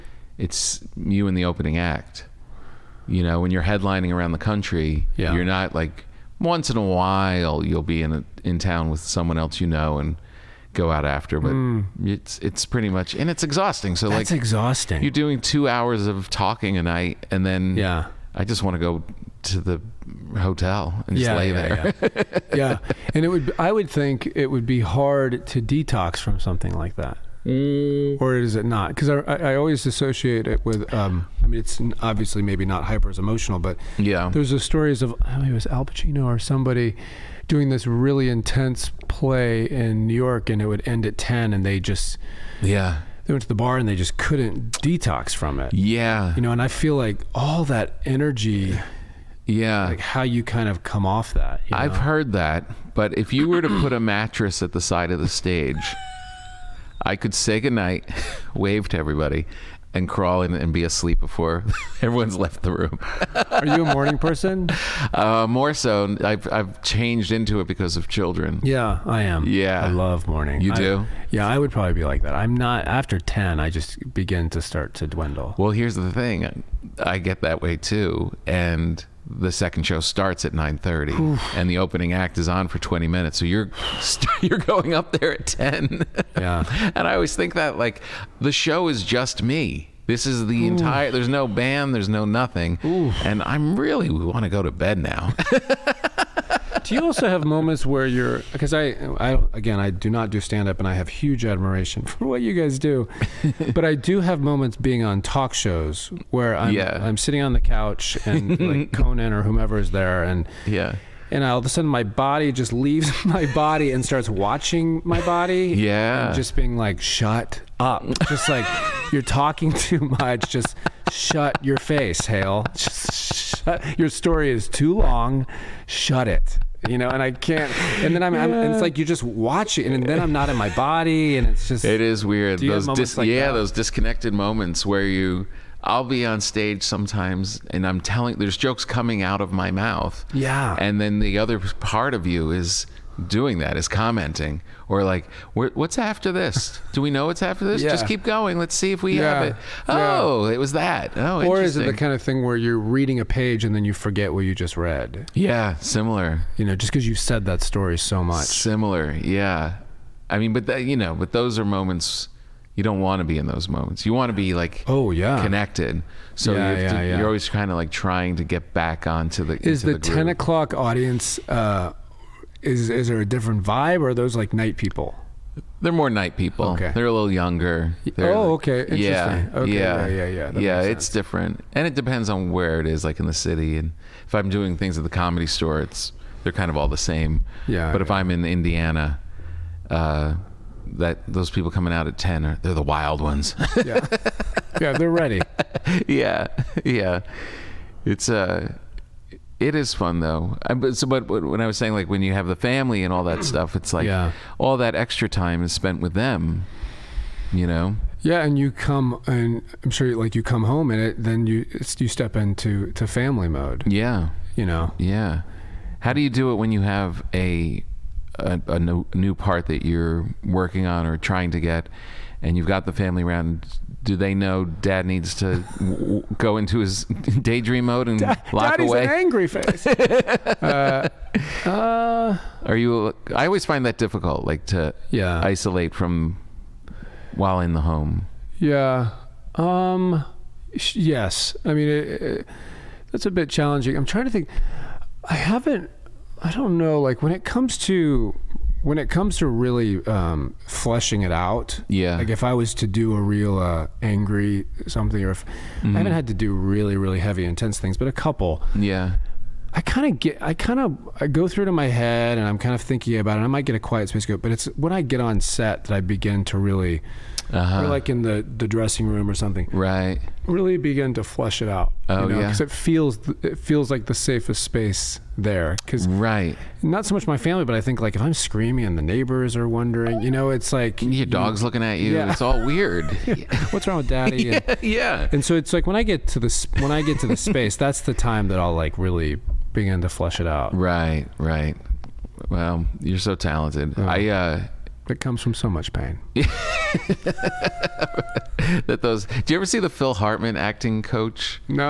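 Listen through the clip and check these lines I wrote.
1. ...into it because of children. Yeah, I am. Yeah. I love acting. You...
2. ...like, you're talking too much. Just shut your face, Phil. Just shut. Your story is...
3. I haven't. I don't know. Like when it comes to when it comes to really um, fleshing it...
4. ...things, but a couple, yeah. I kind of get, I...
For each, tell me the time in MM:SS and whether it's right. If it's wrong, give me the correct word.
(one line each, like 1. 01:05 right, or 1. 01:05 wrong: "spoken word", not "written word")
1. 01:07 wrong: "morning", not "acting"
2. 01:58 wrong: "Hale", not "Phil"
3. 04:05 right
4. 04:17 right.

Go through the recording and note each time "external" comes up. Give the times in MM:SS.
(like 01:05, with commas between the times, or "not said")
not said.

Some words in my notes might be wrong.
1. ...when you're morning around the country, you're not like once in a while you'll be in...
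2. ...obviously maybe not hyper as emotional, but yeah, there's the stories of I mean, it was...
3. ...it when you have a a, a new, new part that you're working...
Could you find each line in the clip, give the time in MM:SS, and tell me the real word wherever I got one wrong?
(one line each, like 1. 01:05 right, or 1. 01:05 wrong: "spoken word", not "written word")
1. 00:03 wrong: "headlining", not "morning"
2. 00:32 right
3. 03:36 right.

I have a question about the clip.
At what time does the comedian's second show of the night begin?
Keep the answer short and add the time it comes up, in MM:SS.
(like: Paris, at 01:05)
9:30, at 01:20.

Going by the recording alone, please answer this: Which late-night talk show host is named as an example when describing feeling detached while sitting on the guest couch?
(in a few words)
Conan.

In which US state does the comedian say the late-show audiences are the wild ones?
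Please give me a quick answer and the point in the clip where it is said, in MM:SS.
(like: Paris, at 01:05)
Indiana, at 03:08.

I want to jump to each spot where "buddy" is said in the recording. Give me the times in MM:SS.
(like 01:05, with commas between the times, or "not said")
not said.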